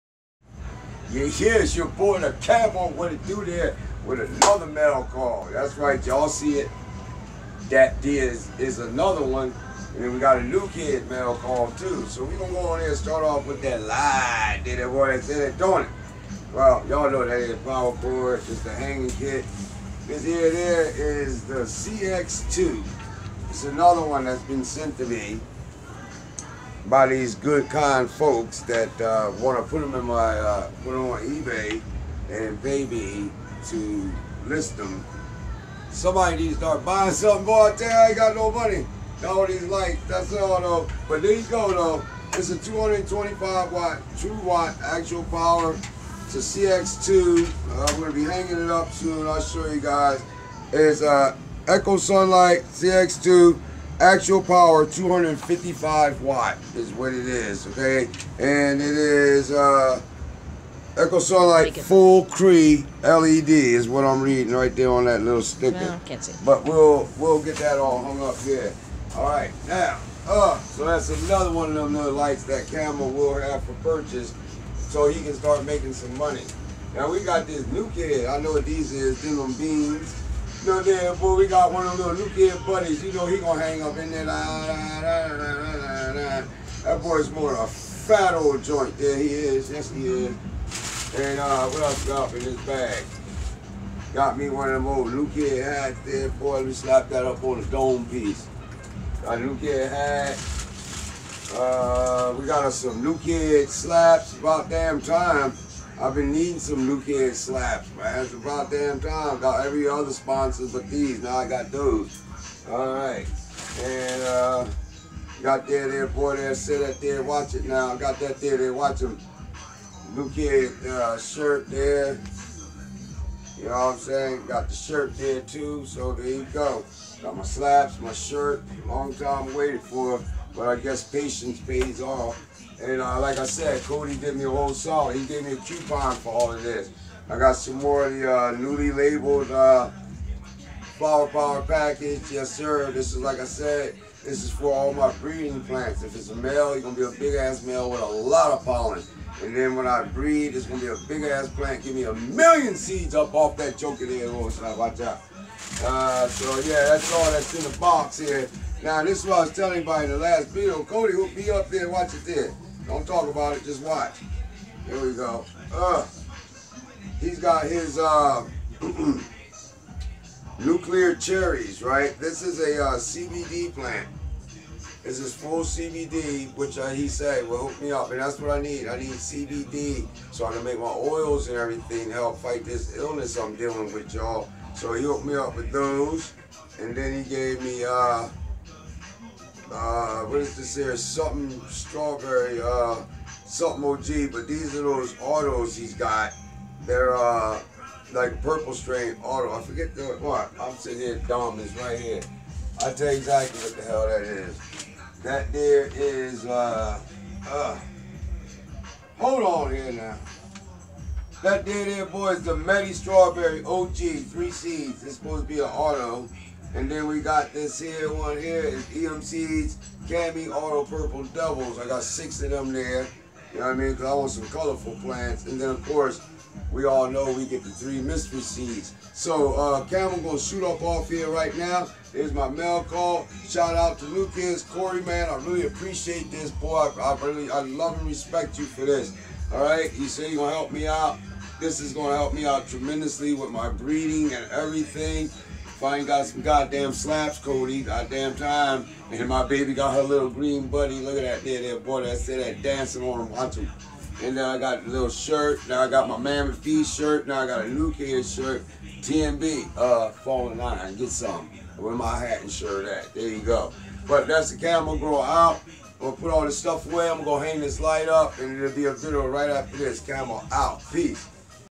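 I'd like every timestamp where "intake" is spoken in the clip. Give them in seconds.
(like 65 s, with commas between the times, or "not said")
not said.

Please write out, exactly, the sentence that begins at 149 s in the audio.
And then when I breed, it's going to be a big-ass plant.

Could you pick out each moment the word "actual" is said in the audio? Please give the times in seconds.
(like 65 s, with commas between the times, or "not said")
44 s, 54 s.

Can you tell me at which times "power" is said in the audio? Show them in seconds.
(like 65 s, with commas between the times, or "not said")
17 s, 45 s, 54 s, 141 s.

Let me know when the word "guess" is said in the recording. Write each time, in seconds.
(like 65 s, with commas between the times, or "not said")
130 s.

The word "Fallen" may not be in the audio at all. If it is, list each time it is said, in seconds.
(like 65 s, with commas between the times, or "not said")
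260 s.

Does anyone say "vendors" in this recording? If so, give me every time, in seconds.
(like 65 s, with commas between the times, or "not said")
not said.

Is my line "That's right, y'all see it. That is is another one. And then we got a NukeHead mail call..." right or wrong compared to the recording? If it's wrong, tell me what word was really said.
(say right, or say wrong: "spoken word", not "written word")
right.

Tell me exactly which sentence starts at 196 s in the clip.
They're uh, like purple strain auto.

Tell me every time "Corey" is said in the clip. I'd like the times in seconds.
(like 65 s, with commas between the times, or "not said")
234 s.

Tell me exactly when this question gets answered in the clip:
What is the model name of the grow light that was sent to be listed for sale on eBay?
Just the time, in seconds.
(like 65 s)
20 s.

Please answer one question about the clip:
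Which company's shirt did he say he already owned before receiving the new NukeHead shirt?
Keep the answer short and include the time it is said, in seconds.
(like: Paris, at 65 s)
Mammoth P, at 256 s.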